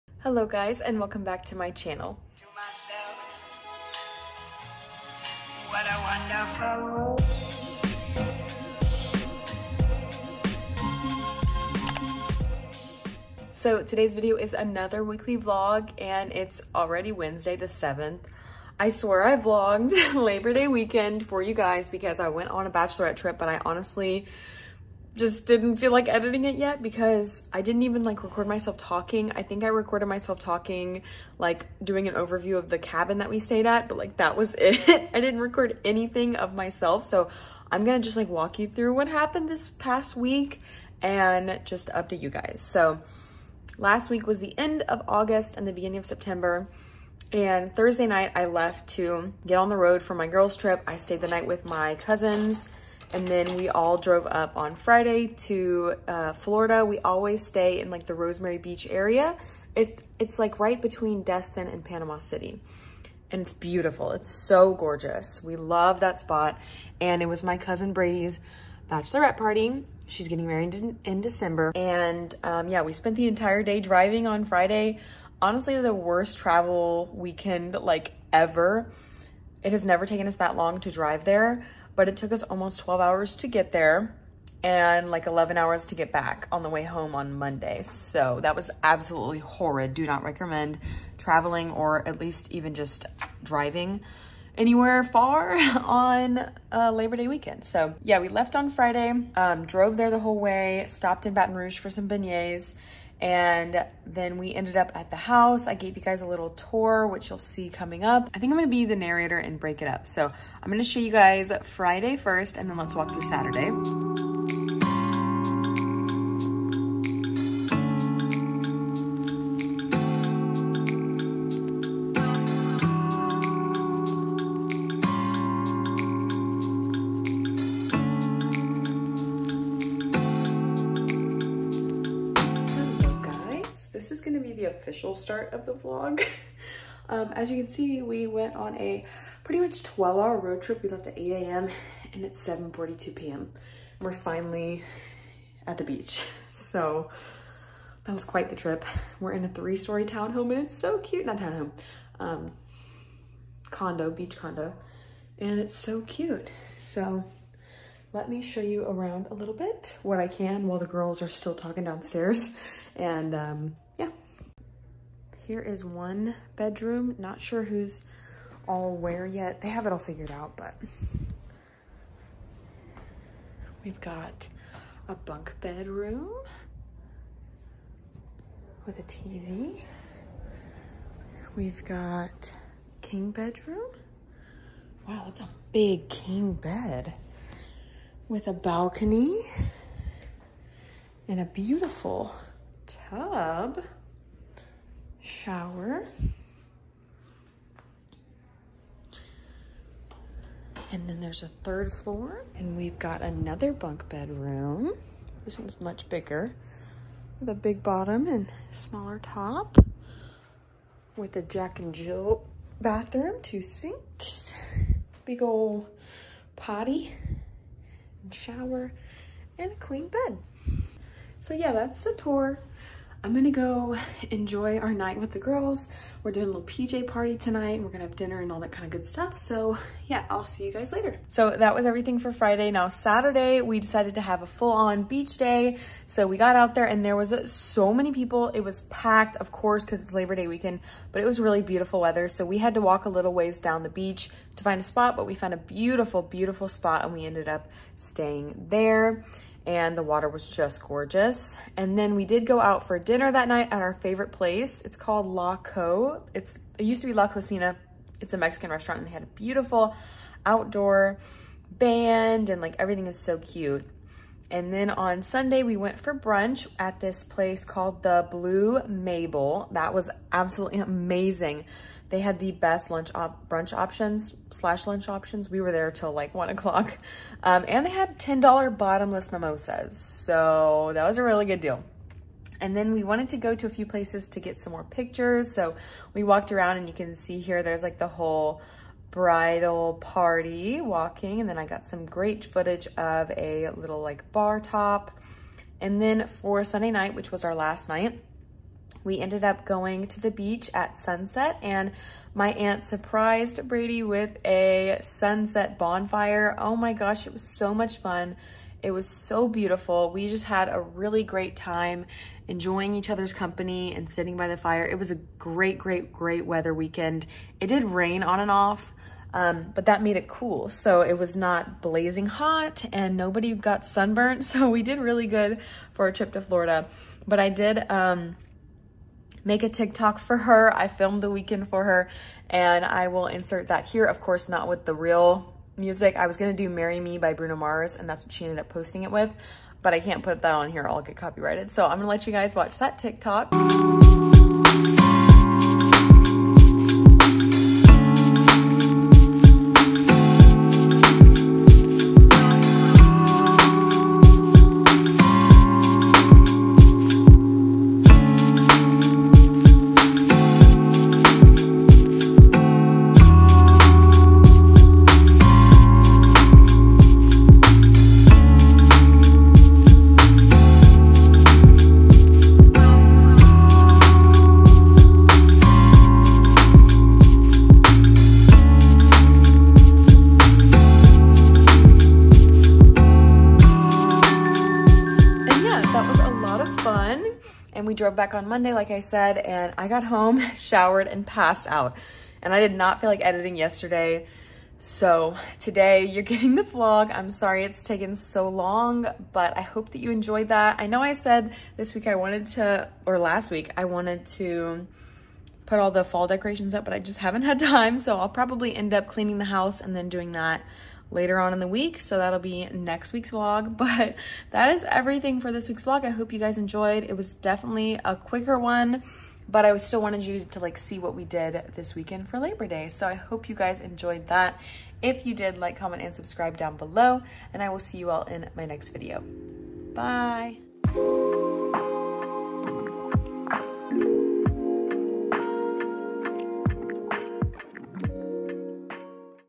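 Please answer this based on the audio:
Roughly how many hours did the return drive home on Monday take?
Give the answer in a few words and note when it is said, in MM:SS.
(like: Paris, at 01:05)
11 hours, at 01:25.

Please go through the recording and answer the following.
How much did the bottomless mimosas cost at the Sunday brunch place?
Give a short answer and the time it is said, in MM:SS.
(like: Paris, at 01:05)
$10, at 04:38.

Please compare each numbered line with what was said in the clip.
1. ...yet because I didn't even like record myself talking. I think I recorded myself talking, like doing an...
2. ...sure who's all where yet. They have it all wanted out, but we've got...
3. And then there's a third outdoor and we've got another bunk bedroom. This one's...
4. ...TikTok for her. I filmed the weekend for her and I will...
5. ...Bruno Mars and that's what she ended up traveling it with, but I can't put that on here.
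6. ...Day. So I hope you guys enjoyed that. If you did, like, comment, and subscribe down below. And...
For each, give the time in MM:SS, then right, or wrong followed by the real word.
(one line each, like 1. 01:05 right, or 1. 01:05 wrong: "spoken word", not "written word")
1. 00:26 right
2. 02:47 wrong: "figured", not "wanted"
3. 03:20 wrong: "floor", not "outdoor"
4. 05:29 right
5. 05:37 wrong: "posting", not "traveling"
6. 07:02 right.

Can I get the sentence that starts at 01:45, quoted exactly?
I gave you guys a little tour, which you'll see coming up.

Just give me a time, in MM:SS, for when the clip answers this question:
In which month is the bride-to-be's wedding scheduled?
01:11.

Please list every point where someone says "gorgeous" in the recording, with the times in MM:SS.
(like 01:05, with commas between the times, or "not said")
01:04, 04:10.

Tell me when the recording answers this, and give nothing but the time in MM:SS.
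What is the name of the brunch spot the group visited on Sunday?
04:28.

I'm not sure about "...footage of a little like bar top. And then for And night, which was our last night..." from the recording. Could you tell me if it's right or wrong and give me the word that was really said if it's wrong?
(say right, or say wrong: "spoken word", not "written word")
wrong: "Sunday", not "And".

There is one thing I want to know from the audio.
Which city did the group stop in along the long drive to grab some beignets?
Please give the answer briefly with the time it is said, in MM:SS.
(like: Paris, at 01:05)
Baton Rouge, at 01:41.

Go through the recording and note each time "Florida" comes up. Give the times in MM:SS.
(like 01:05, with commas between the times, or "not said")
00:56, 05:26.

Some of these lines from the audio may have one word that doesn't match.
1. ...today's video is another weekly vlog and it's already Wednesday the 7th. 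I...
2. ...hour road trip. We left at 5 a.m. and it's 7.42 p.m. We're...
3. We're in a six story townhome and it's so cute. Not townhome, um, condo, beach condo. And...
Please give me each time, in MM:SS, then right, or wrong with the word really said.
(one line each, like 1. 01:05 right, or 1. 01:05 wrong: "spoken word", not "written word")
1. 00:13 right
2. 02:20 wrong: "8", not "5"
3. 02:29 wrong: "three", not "six".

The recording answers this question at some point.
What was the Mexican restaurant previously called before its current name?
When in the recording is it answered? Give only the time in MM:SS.
04:17.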